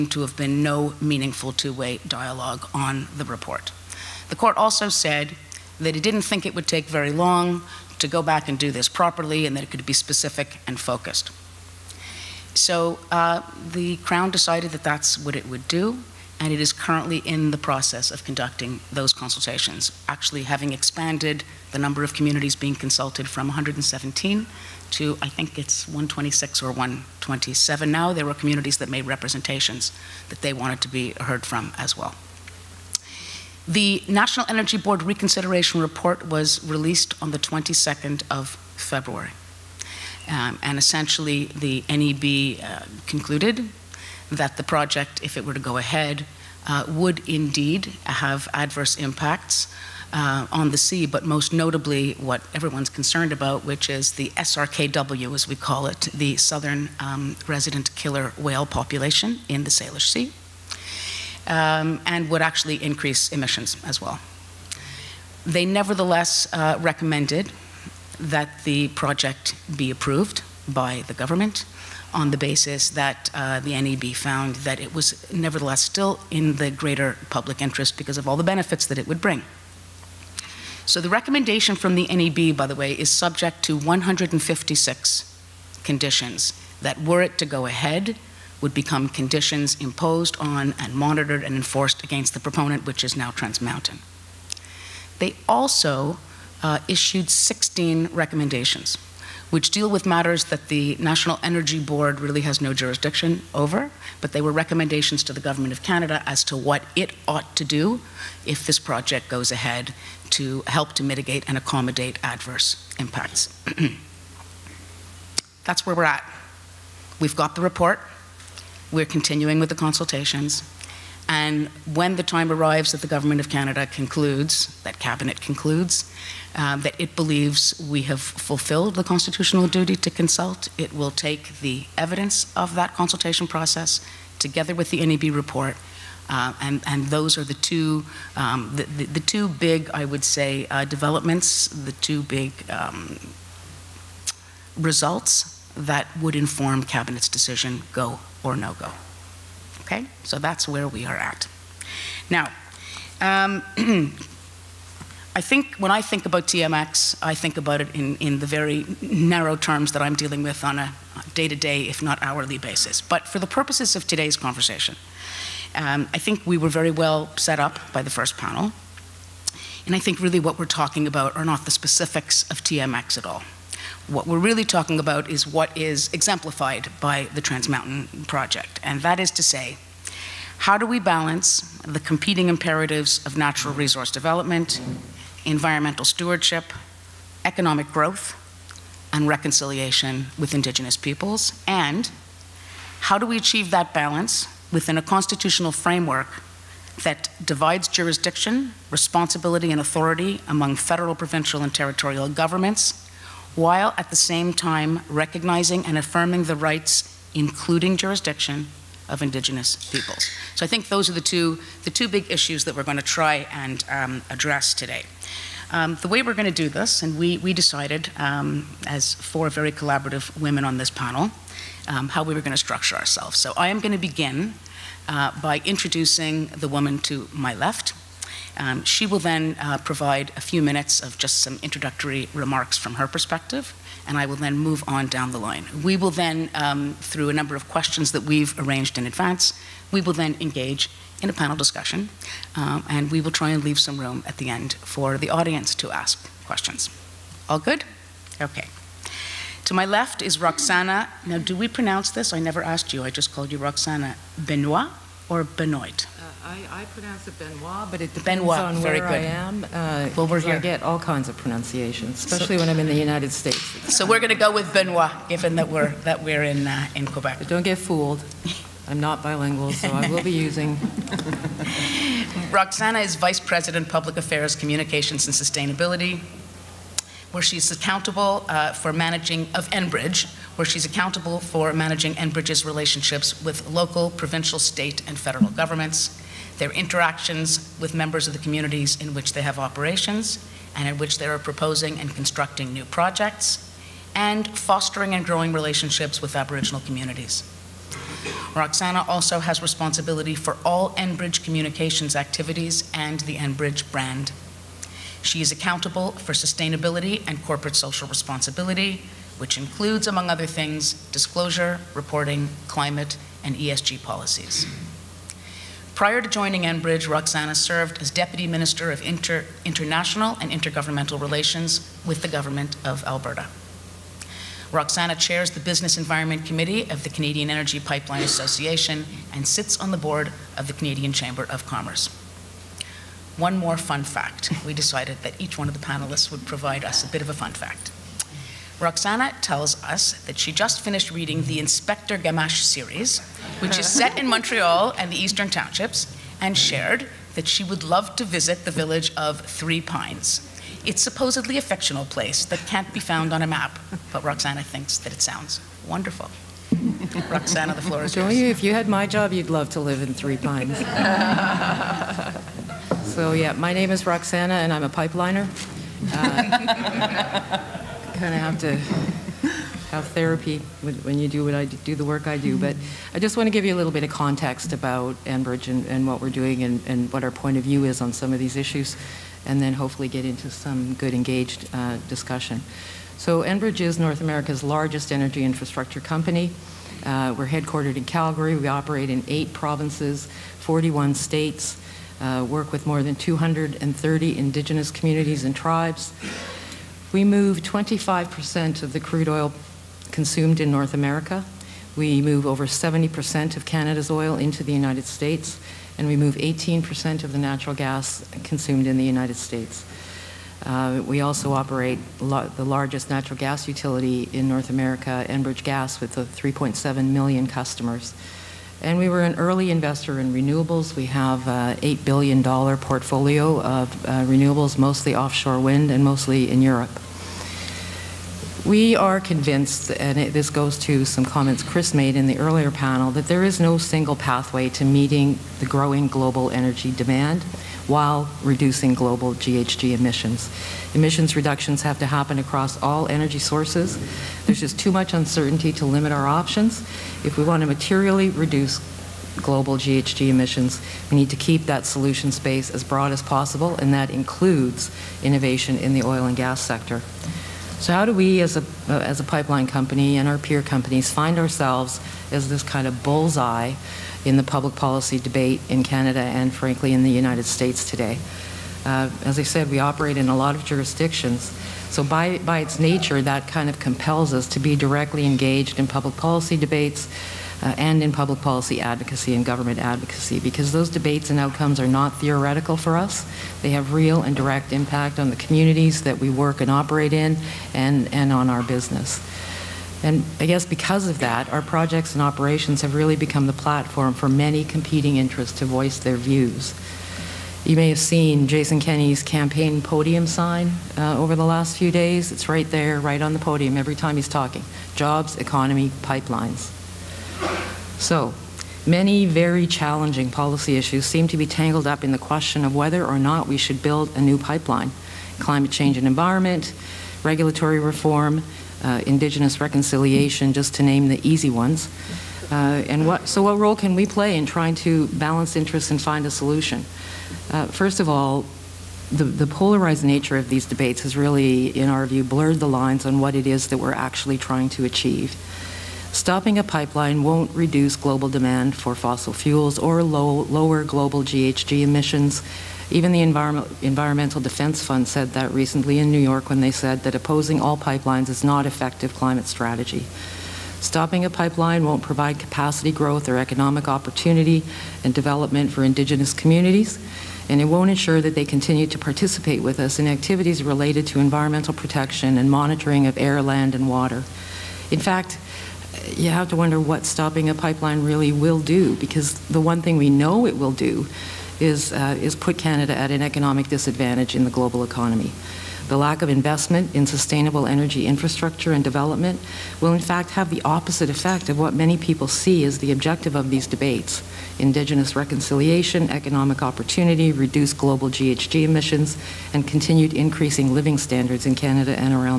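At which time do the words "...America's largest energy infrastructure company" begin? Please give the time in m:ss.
6:24.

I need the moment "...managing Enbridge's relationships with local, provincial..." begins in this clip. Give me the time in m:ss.
4:41.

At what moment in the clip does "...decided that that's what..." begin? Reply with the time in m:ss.
0:14.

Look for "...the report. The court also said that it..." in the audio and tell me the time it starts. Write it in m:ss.
0:03.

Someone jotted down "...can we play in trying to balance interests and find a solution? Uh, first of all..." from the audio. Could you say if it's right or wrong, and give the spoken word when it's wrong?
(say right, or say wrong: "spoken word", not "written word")
right.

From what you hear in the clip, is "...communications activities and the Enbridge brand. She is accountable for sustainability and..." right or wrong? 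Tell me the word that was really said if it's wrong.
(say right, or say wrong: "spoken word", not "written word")
right.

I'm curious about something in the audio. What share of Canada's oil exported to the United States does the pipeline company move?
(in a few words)
over 70%.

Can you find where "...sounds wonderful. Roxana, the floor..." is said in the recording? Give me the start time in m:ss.
5:55.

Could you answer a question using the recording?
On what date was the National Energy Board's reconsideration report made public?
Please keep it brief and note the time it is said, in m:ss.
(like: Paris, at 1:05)
22nd of February, at 0:37.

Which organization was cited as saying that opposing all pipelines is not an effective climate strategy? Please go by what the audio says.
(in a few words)
Environmental Defense Fund.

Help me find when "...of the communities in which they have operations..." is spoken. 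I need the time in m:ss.
4:48.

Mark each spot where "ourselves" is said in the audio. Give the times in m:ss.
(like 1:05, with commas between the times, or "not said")
3:42, 7:41.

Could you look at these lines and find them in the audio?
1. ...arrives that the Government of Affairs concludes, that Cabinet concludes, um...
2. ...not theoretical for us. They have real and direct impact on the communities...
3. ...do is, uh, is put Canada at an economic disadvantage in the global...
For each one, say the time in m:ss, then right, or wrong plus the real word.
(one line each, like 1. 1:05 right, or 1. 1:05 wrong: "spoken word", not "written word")
1. 2:02 wrong: "Canada", not "Affairs"
2. 8:01 right
3. 9:30 right.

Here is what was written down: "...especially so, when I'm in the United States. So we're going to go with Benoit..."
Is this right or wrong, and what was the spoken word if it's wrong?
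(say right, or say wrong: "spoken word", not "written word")
right.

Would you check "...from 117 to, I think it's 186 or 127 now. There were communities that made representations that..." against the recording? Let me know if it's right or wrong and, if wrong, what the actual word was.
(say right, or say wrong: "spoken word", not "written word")
wrong: "126", not "186".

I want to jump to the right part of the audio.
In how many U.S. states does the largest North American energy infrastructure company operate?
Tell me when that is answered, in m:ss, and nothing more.
6:30.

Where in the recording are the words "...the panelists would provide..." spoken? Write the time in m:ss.
5:35.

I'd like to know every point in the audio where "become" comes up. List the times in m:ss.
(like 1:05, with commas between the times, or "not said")
1:28, 8:13.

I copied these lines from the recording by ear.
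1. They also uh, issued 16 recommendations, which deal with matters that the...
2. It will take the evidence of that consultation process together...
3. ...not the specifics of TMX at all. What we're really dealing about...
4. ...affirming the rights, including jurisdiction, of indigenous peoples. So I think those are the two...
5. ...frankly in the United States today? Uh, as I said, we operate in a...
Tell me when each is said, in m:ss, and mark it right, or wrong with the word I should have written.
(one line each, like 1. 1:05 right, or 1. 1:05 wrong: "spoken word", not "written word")
1. 1:35 right
2. 2:10 right
3. 2:51 wrong: "talking", not "dealing"
4. 3:25 right
5. 7:46 right.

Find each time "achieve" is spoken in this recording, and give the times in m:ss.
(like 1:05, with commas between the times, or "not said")
3:13, 8:54.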